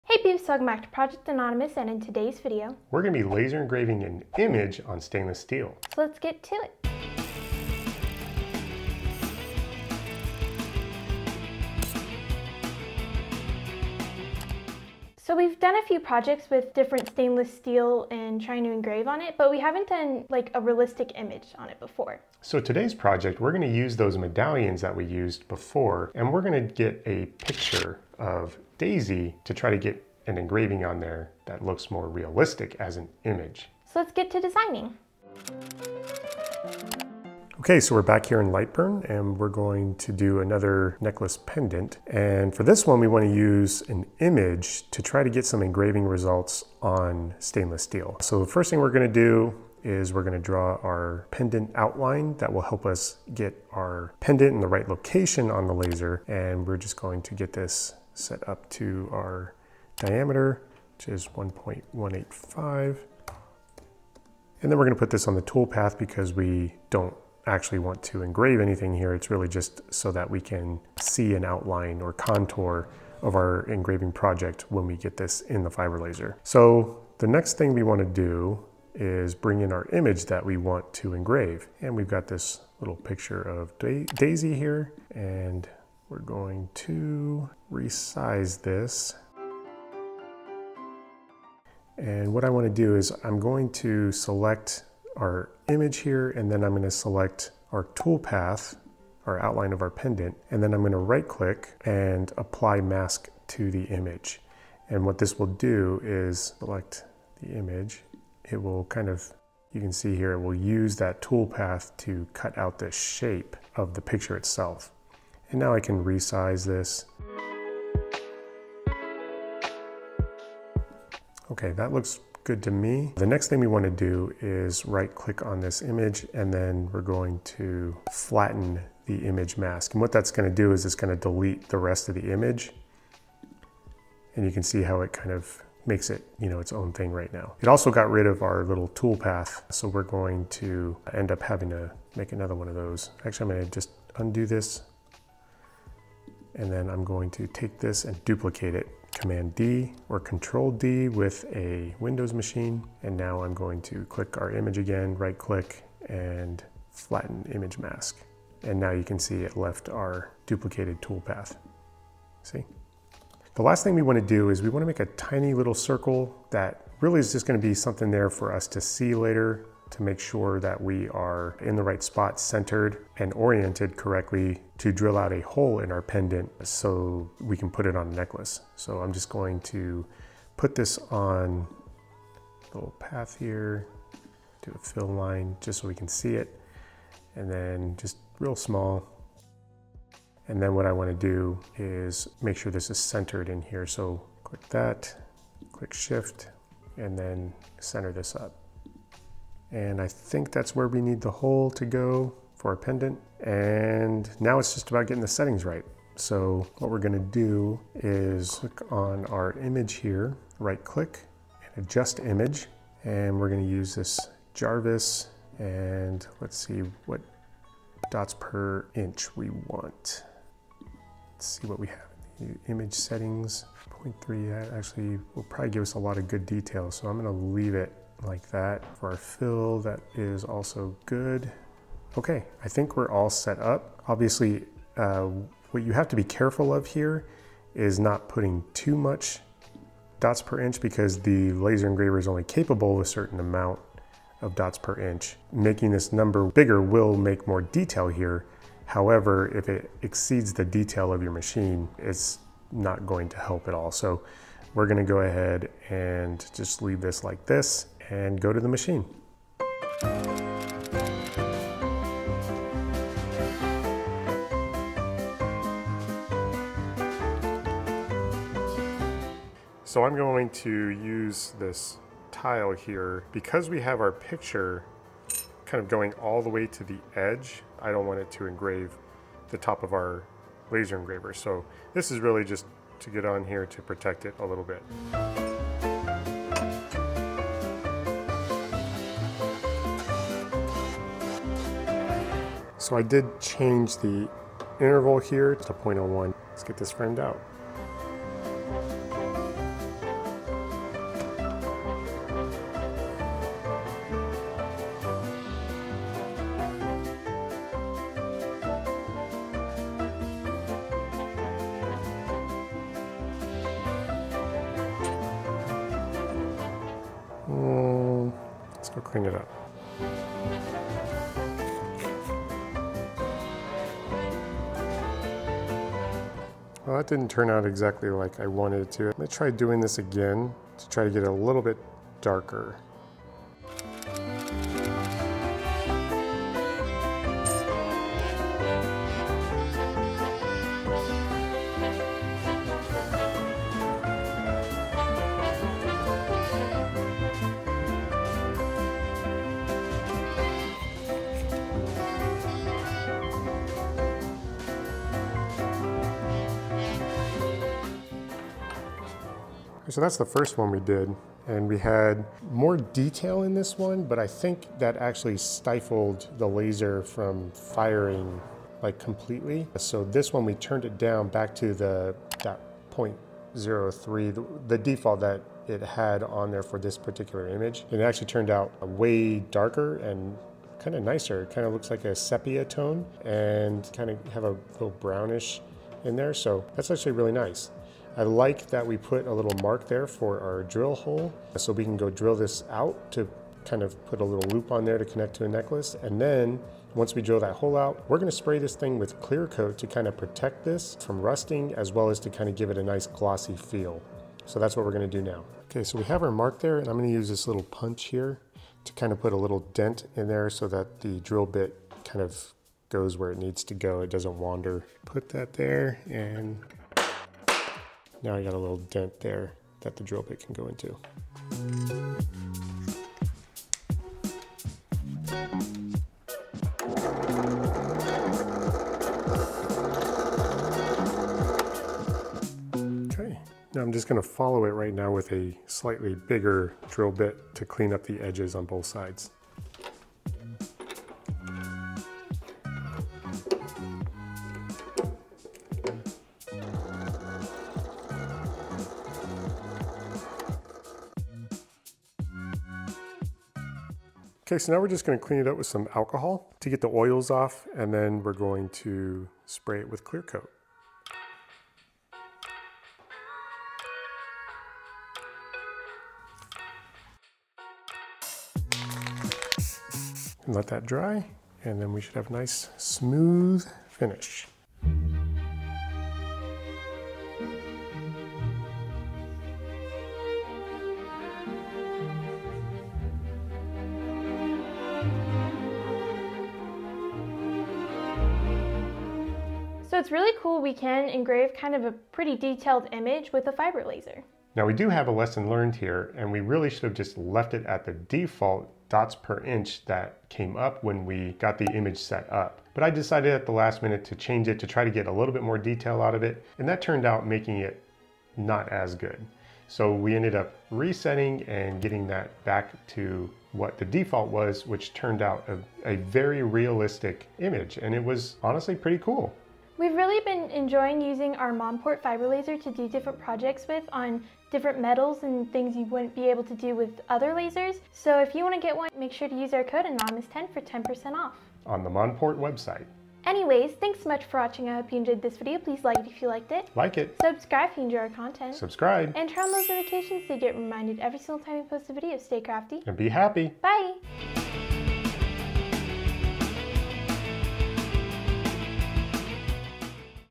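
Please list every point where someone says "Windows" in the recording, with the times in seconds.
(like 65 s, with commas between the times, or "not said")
151 s.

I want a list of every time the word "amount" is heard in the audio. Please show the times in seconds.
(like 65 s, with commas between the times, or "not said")
243 s.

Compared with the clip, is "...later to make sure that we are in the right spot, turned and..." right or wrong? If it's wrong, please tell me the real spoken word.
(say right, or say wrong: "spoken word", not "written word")
wrong: "centered", not "turned".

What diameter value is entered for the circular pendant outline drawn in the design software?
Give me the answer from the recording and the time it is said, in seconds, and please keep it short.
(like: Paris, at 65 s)
1.185, at 61 s.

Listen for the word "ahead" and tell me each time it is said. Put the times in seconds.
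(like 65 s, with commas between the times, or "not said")
255 s.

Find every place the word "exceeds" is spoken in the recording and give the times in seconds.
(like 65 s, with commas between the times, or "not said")
250 s.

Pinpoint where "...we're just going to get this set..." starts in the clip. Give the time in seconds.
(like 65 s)
56 s.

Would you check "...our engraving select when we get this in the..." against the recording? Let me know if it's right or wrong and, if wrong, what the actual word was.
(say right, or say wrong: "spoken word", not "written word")
wrong: "project", not "select".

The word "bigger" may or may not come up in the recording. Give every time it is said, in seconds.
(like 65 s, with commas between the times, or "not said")
246 s, 436 s.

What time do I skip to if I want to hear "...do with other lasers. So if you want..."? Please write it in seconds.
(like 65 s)
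526 s.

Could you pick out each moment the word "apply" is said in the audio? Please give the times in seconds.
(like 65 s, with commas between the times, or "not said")
102 s.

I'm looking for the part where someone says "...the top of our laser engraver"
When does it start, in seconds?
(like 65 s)
279 s.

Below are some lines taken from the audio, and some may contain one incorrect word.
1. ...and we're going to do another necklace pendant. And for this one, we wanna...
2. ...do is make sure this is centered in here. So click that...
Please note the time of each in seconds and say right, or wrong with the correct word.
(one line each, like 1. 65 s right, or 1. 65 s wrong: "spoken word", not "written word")
1. 39 s right
2. 191 s right.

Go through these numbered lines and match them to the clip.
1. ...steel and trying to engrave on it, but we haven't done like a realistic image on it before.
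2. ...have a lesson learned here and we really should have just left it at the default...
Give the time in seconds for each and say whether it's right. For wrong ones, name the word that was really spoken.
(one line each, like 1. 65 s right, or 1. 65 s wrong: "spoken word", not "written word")
1. 17 s right
2. 494 s right.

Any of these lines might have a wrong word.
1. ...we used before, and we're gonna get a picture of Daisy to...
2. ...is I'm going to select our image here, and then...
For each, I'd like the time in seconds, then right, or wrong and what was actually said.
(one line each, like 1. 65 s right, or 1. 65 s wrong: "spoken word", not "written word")
1. 24 s right
2. 92 s right.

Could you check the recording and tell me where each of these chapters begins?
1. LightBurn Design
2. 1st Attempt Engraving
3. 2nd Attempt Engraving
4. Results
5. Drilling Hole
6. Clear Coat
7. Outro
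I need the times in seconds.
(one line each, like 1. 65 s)
1. 36 s
2. 262 s
3. 334 s
4. 360 s
5. 406 s
6. 468 s
7. 490 s.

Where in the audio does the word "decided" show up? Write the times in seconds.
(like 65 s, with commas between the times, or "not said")
502 s.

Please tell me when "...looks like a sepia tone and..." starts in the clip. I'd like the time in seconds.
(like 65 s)
381 s.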